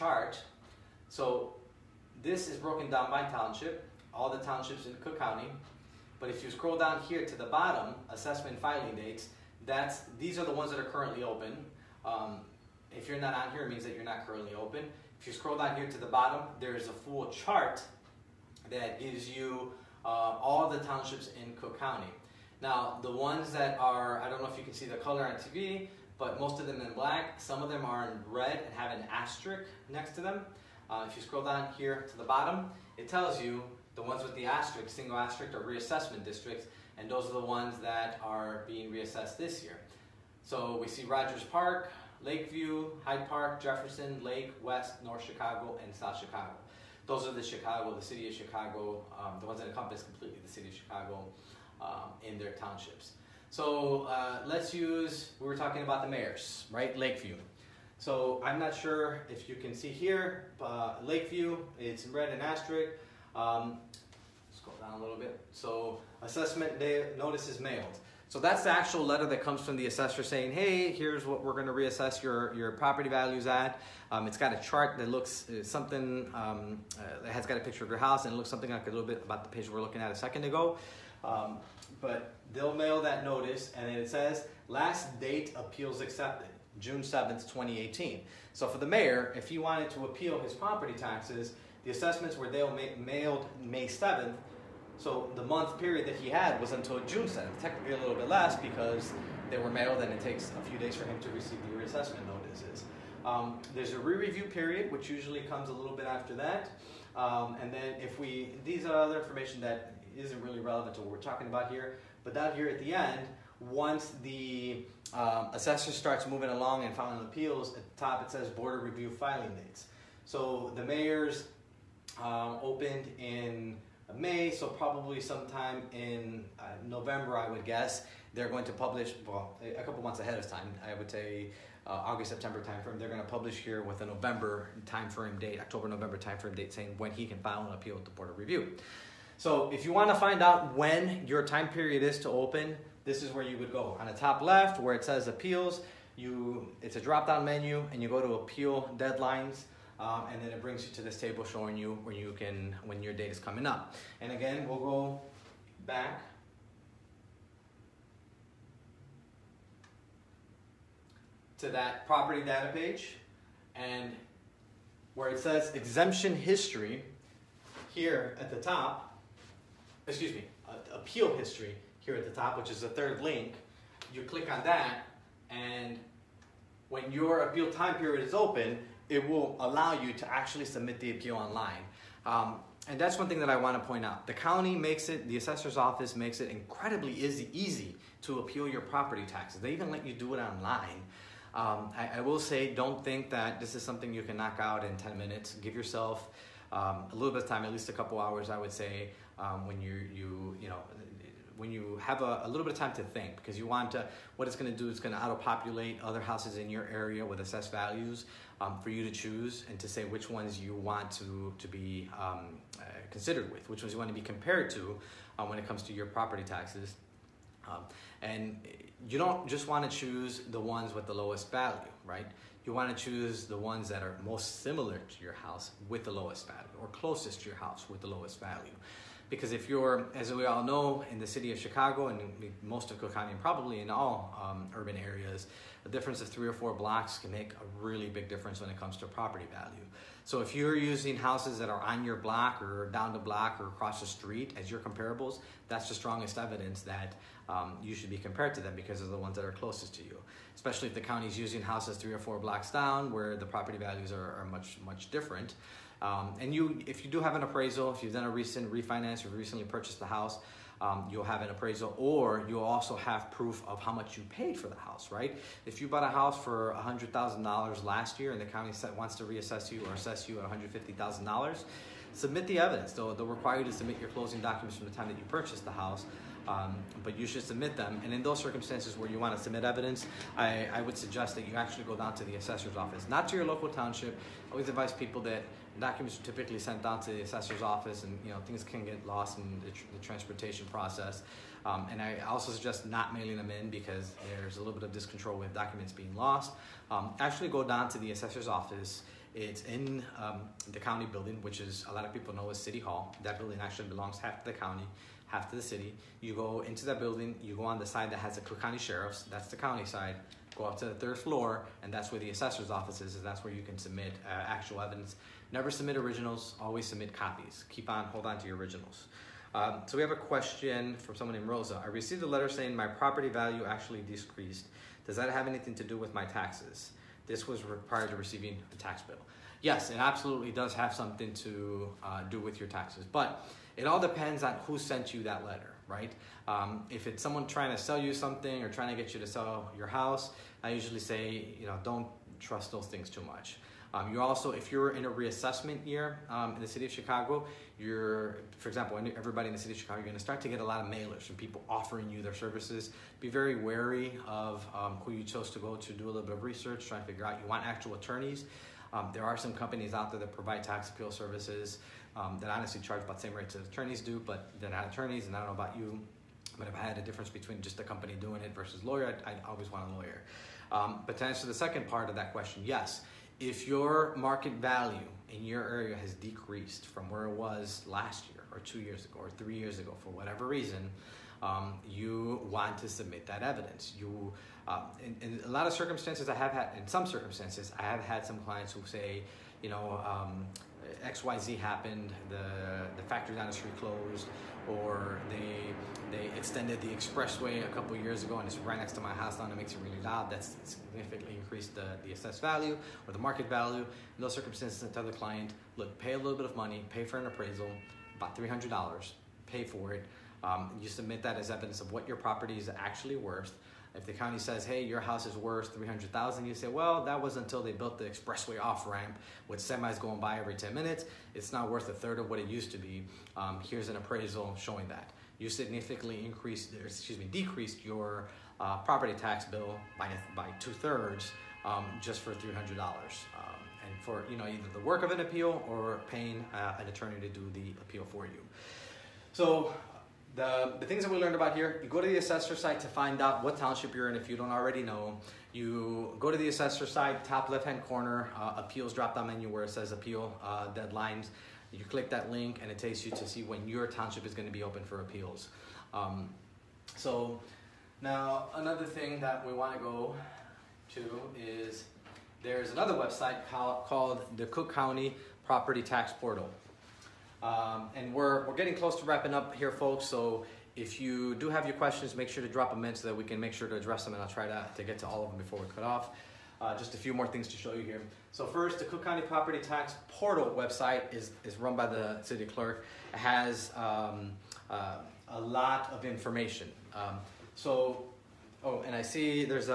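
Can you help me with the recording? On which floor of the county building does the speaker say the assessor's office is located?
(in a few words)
third floor.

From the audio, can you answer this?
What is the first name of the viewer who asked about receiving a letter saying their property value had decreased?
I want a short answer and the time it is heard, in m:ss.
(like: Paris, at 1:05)
Rosa, at 5:21.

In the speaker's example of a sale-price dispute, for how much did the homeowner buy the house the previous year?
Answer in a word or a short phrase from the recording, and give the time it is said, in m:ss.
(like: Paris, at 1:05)
$100,000, at 4:26.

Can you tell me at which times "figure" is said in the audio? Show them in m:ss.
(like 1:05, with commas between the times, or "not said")
5:57.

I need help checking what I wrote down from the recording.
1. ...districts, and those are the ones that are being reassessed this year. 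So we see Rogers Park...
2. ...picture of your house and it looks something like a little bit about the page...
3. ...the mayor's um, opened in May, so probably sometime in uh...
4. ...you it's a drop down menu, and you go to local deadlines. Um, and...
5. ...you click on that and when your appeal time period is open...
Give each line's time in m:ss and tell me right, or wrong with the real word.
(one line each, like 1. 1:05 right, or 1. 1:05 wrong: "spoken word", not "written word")
1. 0:36 right
2. 1:17 right
3. 2:00 right
4. 2:26 wrong: "appeal", not "local"
5. 2:54 right.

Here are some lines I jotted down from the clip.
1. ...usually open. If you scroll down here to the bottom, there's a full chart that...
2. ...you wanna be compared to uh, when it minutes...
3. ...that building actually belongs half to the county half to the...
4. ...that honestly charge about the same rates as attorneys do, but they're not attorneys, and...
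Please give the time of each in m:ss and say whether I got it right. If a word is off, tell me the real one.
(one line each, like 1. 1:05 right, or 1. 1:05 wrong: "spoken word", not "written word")
1. 0:14 wrong: "currently", not "usually"
2. 3:33 wrong: "comes", not "minutes"
3. 5:03 right
4. 6:02 right.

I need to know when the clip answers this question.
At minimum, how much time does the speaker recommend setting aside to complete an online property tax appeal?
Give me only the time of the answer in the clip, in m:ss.
3:17.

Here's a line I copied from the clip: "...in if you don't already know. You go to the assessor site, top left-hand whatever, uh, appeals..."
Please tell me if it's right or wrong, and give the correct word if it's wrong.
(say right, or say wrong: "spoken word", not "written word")
wrong: "corner", not "whatever".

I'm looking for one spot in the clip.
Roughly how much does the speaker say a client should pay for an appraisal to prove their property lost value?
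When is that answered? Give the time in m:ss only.
6:48.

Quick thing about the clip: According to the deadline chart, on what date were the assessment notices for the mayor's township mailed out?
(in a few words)
May 7th.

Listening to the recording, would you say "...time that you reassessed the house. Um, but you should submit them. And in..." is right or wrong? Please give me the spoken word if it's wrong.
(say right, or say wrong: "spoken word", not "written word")
wrong: "purchased", not "reassessed".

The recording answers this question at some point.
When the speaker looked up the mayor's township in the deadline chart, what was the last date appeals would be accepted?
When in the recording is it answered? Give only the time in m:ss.
1:26.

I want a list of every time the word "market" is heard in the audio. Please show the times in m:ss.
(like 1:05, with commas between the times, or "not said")
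6:14, 6:43.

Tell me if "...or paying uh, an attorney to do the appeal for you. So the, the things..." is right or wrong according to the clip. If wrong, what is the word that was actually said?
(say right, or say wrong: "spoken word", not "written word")
right.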